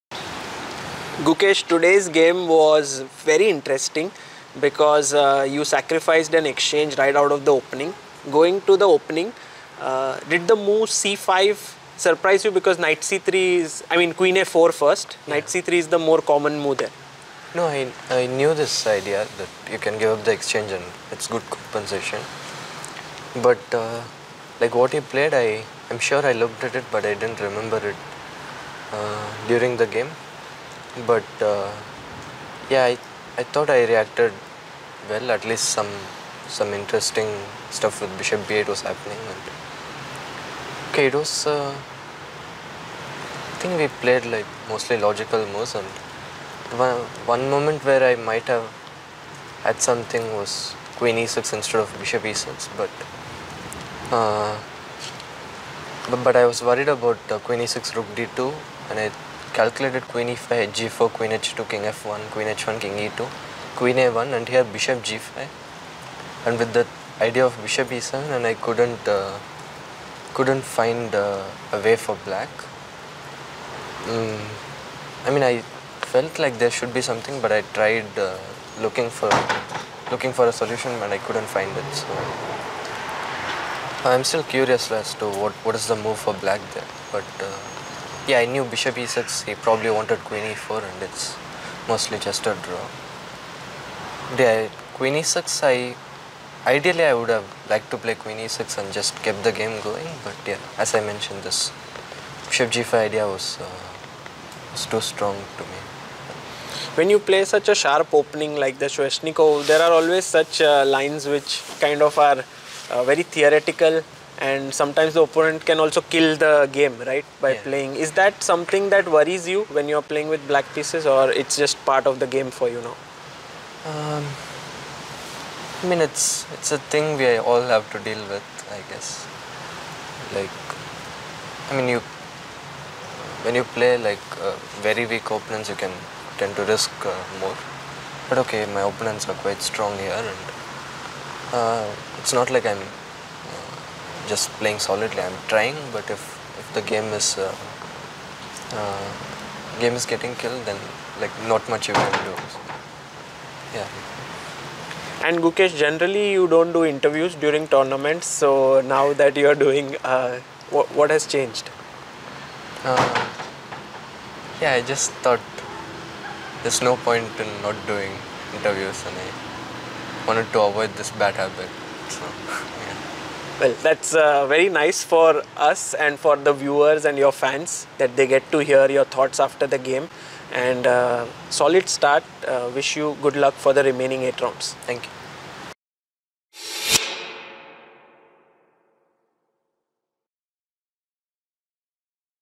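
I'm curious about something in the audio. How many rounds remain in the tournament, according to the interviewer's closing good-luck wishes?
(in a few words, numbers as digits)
8.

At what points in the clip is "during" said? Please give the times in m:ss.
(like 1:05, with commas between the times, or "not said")
0:29, 2:37.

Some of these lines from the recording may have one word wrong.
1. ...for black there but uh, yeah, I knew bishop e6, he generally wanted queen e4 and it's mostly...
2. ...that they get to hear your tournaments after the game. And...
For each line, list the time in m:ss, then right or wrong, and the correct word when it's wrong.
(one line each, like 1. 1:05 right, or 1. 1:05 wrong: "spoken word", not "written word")
1. 1:26 wrong: "probably", not "generally"
2. 2:57 wrong: "thoughts", not "tournaments".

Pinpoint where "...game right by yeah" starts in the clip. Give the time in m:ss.
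1:56.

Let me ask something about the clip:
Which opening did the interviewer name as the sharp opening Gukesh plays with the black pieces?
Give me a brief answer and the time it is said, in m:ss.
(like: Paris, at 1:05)
Sveshnikov, at 1:48.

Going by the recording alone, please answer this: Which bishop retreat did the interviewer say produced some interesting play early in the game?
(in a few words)
Bishop b8.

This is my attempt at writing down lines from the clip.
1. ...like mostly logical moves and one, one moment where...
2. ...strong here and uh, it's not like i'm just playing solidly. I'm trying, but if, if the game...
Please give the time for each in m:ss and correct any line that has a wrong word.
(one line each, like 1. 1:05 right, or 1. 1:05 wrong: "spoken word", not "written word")
1. 0:44 right
2. 2:19 right.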